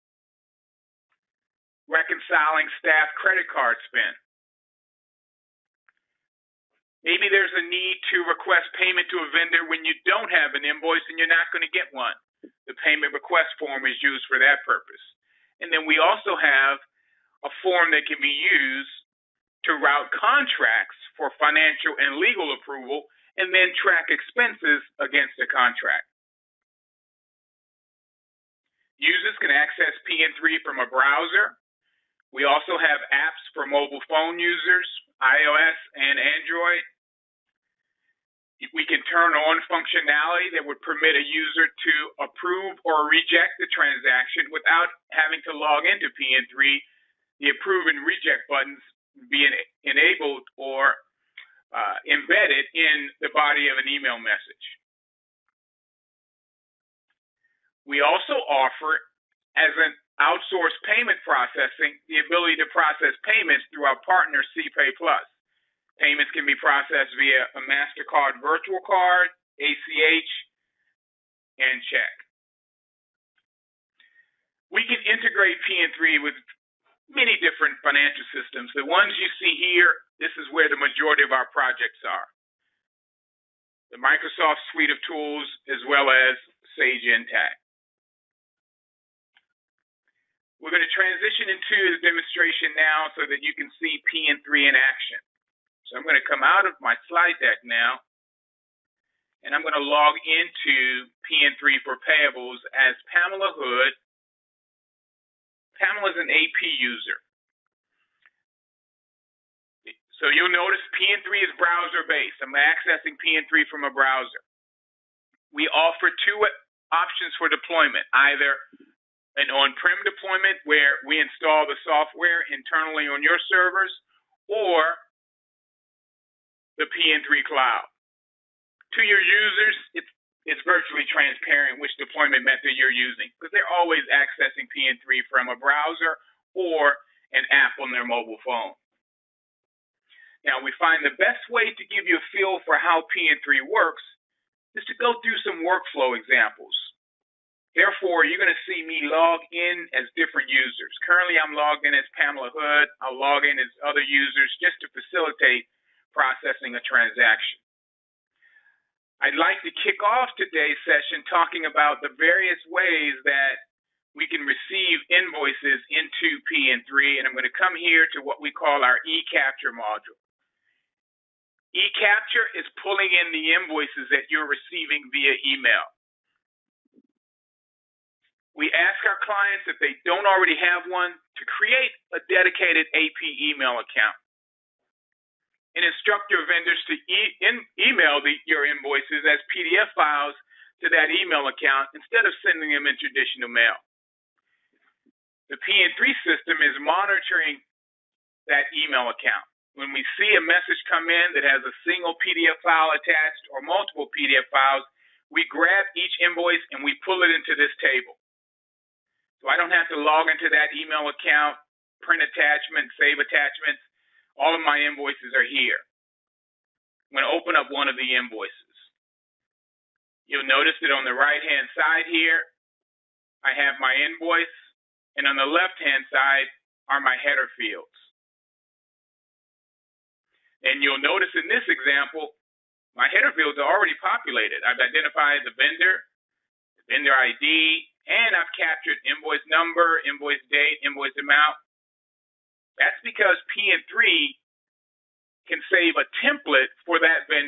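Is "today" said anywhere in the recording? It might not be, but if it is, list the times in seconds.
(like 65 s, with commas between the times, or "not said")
160 s.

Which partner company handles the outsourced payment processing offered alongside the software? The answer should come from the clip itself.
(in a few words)
CPay Plus.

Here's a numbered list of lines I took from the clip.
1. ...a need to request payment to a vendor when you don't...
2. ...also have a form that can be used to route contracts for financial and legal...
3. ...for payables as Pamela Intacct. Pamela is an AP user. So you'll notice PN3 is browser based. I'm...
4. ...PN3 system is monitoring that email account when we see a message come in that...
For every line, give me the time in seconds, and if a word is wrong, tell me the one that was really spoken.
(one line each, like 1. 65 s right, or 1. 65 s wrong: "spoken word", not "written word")
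1. 7 s right
2. 15 s right
3. 101 s wrong: "Hood", not "Intacct"
4. 195 s right.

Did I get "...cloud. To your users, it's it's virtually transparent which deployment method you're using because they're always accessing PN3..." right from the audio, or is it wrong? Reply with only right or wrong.
right.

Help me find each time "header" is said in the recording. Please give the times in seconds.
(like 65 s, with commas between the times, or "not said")
227 s, 233 s.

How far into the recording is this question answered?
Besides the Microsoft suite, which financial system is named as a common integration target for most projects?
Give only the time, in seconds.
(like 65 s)
86 s.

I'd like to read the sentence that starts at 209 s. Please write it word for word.
So I don't have to log into that email account, print attachments, save attachments.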